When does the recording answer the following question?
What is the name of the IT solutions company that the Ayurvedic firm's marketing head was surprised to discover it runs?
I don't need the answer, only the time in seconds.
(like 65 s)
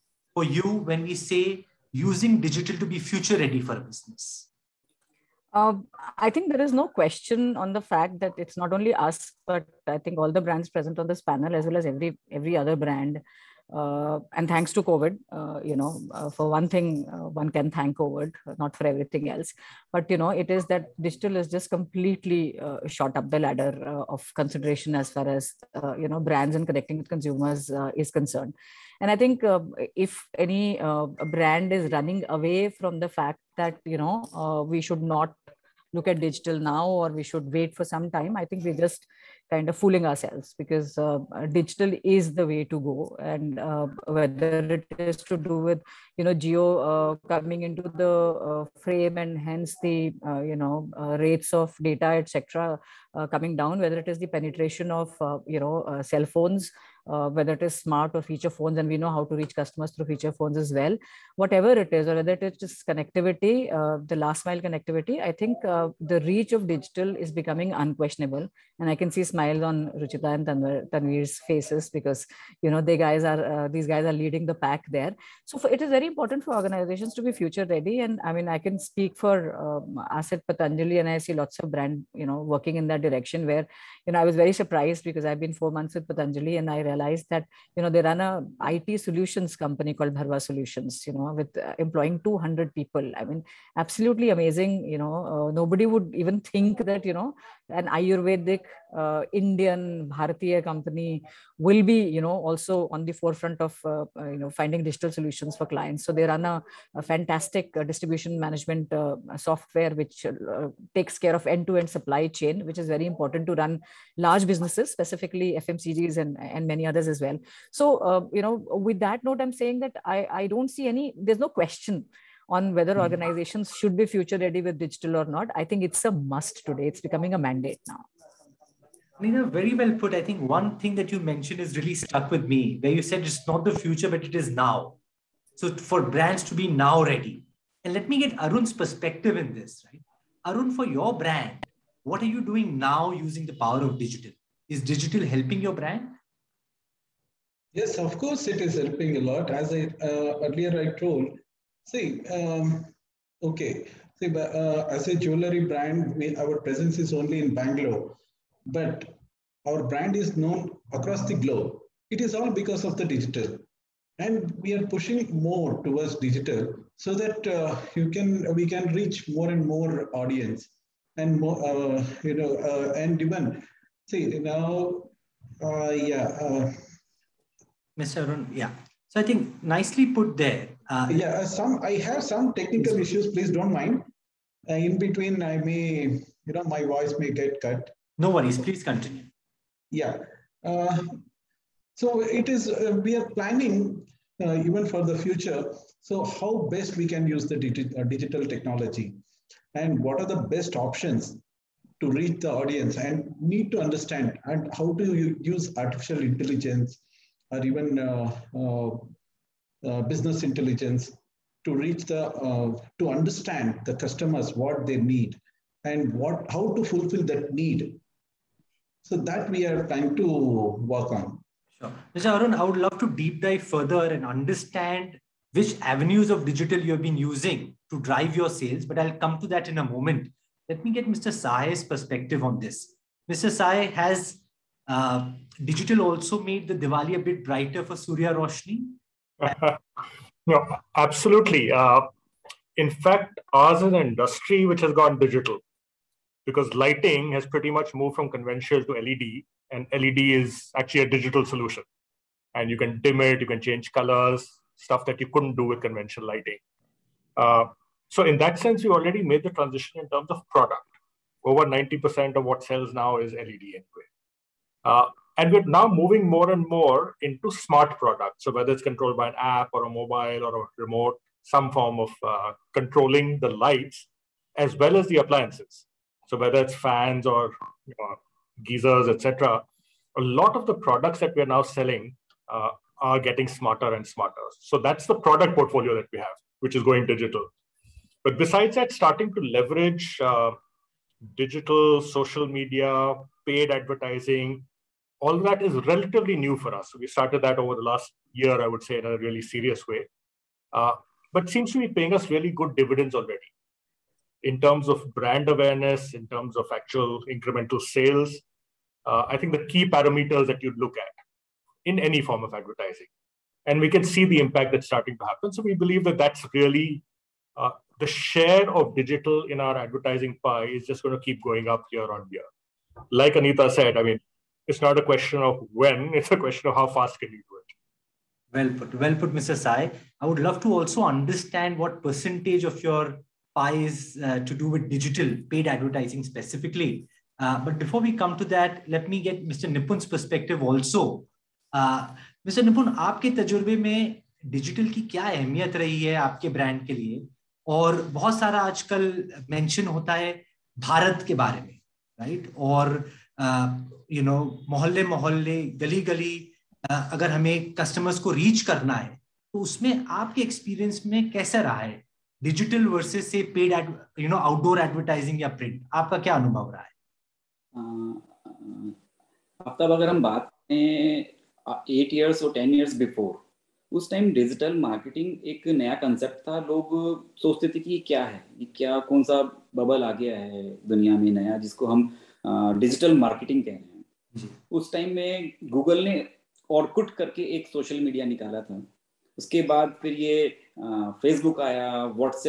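90 s.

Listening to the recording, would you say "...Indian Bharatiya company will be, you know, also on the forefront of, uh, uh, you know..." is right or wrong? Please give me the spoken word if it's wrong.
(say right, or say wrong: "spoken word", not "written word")
right.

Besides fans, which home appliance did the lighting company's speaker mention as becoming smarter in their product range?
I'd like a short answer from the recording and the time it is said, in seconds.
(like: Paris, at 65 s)
Geysers, at 278 s.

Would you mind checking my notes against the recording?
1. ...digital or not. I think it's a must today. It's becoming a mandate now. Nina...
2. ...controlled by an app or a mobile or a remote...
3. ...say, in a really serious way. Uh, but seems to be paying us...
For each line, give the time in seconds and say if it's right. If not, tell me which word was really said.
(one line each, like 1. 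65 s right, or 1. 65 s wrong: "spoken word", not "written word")
1. 124 s right
2. 268 s right
3. 298 s right.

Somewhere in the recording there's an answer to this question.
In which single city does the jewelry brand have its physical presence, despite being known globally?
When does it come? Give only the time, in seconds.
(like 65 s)
157 s.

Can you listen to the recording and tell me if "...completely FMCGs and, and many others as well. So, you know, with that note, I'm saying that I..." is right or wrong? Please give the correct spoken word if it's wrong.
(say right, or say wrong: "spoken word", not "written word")
wrong: "specifically", not "completely".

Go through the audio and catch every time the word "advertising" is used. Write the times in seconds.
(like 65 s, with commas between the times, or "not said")
293 s, 312 s, 319 s, 335 s.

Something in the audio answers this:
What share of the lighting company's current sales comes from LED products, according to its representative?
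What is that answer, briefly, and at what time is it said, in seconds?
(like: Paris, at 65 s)
Over 90%, at 261 s.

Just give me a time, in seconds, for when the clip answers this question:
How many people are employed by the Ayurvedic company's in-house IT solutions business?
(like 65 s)
92 s.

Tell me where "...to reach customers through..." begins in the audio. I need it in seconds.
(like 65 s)
59 s.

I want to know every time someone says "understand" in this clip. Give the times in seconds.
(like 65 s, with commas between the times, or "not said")
203 s, 213 s, 224 s, 331 s.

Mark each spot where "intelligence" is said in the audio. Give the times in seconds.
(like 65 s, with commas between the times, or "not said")
206 s, 210 s.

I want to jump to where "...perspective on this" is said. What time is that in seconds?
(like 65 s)
231 s.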